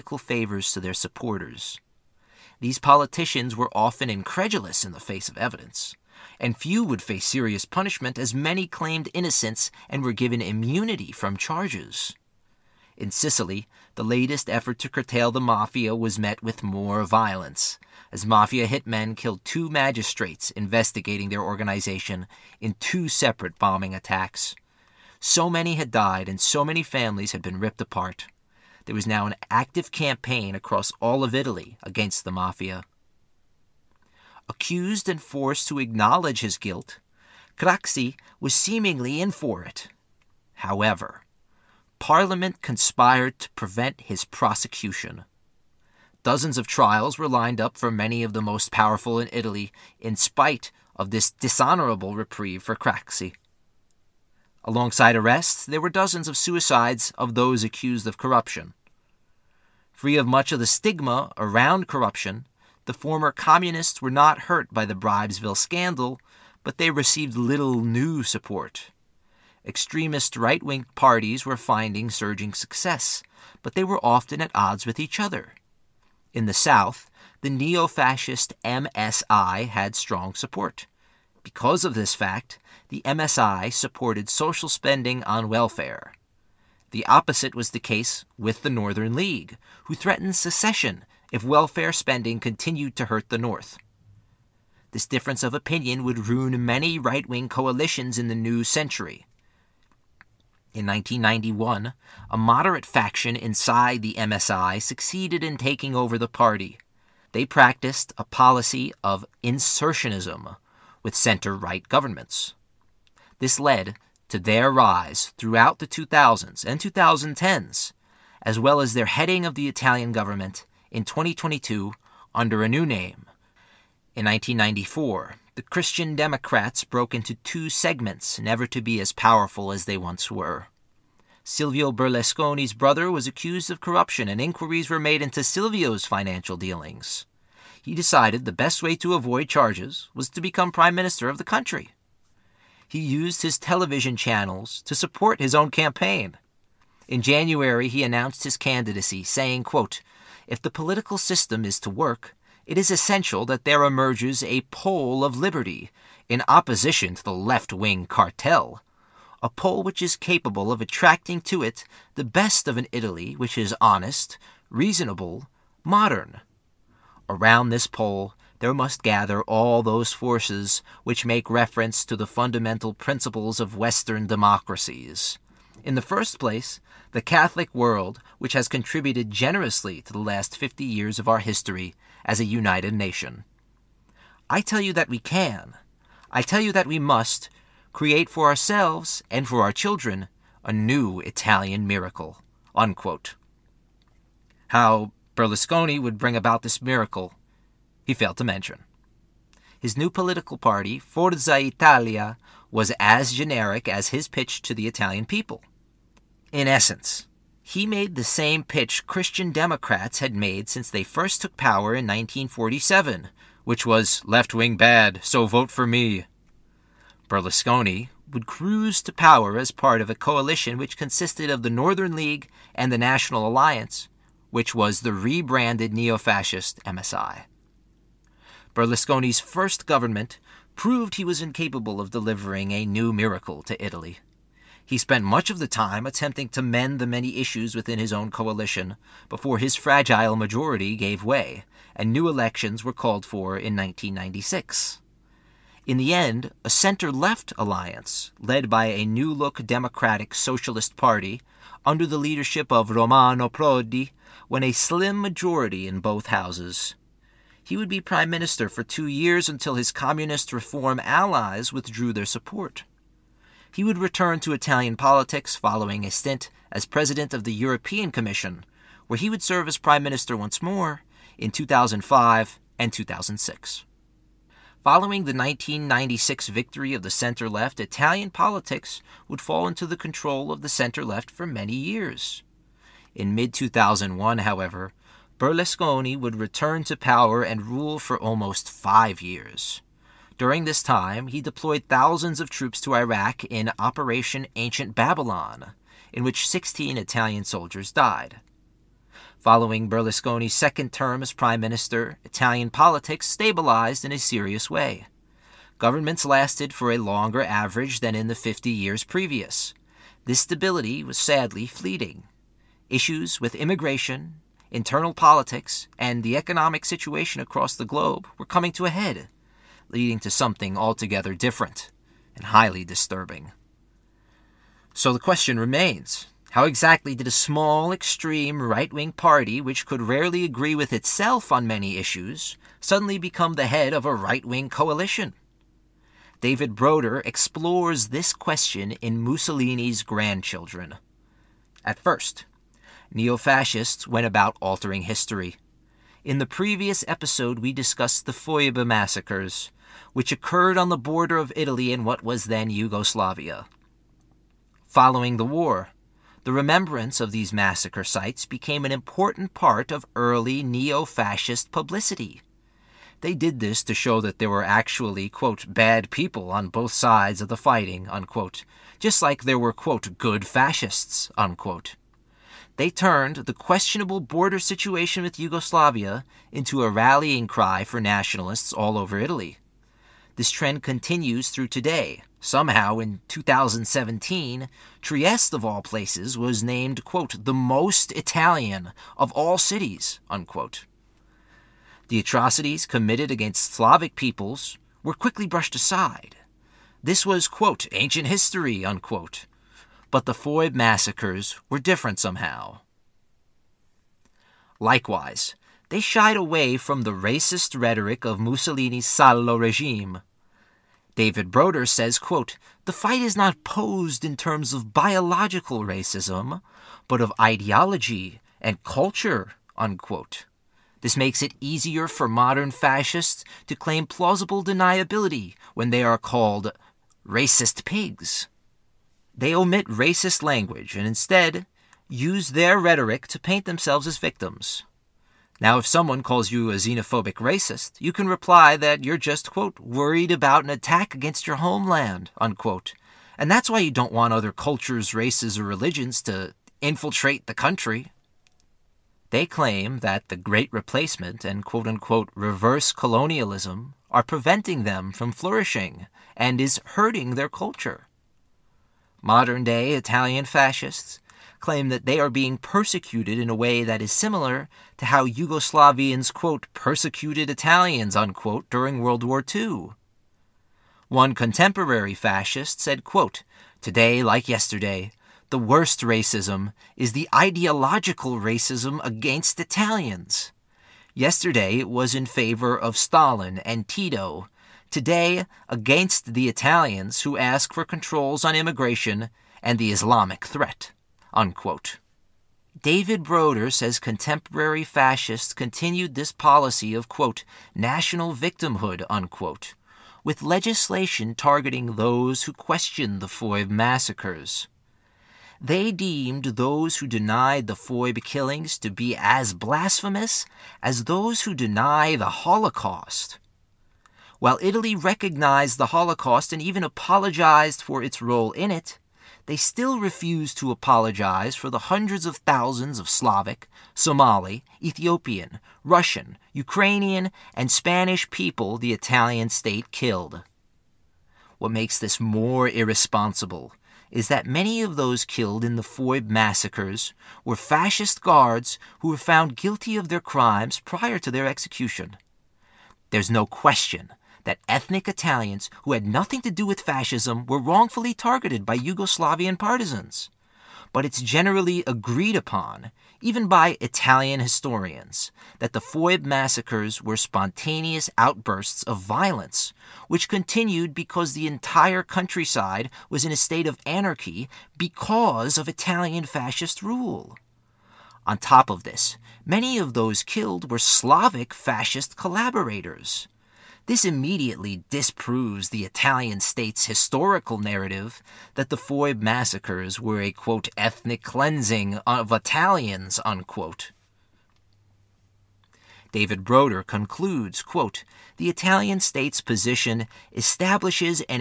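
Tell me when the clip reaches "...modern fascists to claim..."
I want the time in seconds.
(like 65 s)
422 s.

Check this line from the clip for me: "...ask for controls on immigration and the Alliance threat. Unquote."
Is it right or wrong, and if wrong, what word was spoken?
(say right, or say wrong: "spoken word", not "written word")
wrong: "Islamic", not "Alliance".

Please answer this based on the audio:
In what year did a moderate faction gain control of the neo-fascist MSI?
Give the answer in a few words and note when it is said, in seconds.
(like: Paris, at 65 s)
1991, at 100 s.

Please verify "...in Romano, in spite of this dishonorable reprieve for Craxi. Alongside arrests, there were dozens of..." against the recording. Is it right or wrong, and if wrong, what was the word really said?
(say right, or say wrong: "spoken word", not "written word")
wrong: "Italy", not "Romano".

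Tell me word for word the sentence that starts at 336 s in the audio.
David Broder explores this question in Mussolini's Grandchildren.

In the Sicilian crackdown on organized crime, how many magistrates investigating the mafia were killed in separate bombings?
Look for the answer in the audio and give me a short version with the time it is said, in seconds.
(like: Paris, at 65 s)
2, at 19 s.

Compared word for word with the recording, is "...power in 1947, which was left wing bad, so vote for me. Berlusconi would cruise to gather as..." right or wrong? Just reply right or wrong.
wrong.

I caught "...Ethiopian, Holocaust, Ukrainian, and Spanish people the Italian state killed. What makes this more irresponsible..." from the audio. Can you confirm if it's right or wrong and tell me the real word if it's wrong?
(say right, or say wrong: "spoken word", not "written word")
wrong: "Russian", not "Holocaust".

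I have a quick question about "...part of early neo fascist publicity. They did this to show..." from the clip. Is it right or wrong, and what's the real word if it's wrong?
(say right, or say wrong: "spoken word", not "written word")
right.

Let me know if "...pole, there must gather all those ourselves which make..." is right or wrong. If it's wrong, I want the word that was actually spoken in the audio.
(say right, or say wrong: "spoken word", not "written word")
wrong: "forces", not "ourselves".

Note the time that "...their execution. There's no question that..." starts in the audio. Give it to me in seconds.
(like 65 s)
541 s.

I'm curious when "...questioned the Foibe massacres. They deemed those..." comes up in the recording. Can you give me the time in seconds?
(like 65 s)
502 s.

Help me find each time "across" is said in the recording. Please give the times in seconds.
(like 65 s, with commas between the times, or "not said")
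30 s, 317 s.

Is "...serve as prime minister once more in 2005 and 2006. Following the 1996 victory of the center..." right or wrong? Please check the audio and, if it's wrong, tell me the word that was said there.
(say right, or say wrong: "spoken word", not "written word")
right.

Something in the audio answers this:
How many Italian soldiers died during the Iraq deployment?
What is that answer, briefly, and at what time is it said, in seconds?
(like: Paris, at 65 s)
16, at 296 s.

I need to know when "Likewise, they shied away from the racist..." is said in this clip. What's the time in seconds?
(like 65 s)
404 s.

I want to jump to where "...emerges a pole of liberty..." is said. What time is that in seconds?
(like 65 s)
153 s.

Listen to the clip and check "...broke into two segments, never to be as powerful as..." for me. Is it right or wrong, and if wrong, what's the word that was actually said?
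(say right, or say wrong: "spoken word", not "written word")
right.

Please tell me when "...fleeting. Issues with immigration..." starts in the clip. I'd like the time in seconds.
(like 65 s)
311 s.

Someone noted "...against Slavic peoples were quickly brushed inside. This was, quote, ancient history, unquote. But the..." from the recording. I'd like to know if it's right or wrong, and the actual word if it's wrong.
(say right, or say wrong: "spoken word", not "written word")
wrong: "aside", not "inside".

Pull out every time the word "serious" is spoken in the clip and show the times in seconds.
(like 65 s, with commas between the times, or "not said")
7 s, 304 s.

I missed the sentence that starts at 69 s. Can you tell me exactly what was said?
Extremist right wing parties were finding surging success, but they were often at odds with each other.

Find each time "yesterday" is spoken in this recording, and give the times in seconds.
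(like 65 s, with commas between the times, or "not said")
474 s, 481 s.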